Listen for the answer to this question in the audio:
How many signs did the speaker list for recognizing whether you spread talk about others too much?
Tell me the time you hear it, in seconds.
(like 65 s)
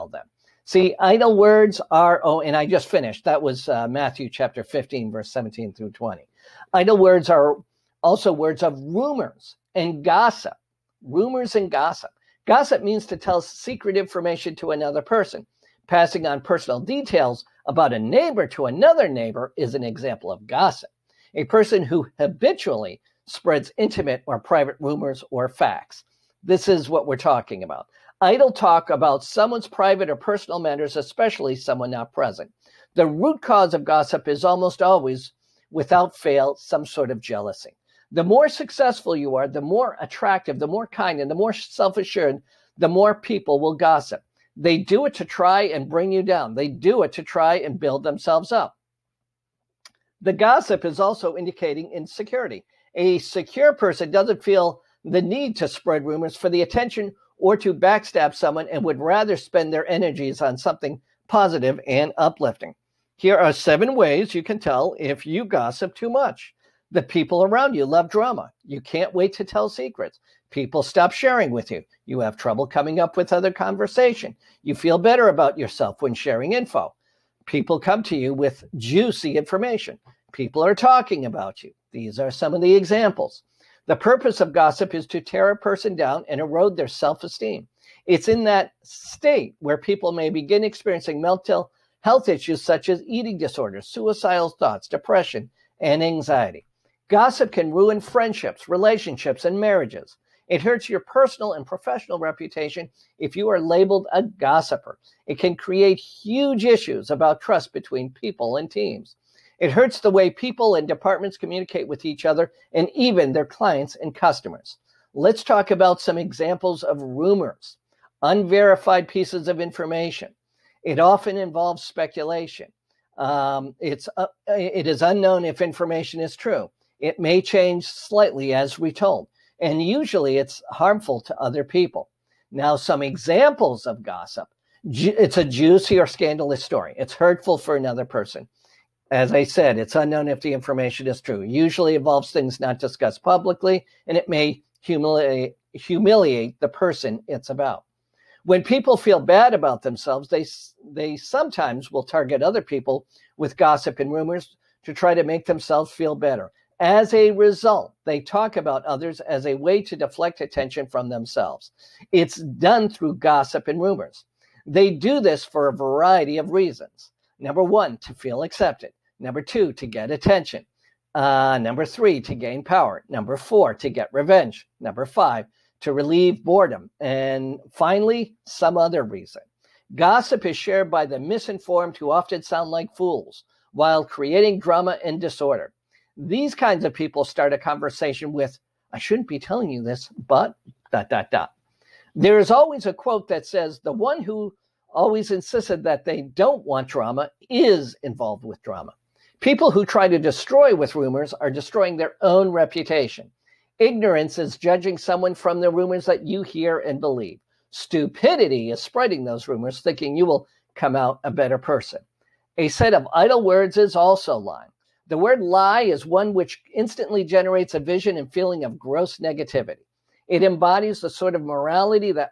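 63 s.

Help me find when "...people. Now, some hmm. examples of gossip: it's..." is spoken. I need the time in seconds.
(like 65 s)
131 s.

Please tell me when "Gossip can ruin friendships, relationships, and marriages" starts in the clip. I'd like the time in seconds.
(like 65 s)
97 s.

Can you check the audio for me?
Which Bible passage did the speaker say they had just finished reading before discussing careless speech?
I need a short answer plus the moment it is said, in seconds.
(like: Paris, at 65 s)
Matthew 15:17-20, at 3 s.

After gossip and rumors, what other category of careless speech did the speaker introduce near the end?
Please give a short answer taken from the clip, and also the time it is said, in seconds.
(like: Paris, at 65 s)
Lying, at 214 s.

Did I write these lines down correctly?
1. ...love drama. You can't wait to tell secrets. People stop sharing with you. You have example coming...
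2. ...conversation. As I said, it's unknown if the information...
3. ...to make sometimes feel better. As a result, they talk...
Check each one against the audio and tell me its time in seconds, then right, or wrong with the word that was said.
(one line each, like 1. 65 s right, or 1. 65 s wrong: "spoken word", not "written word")
1. 67 s wrong: "trouble", not "example"
2. 138 s wrong: "person", not "conversation"
3. 155 s wrong: "themselves", not "sometimes".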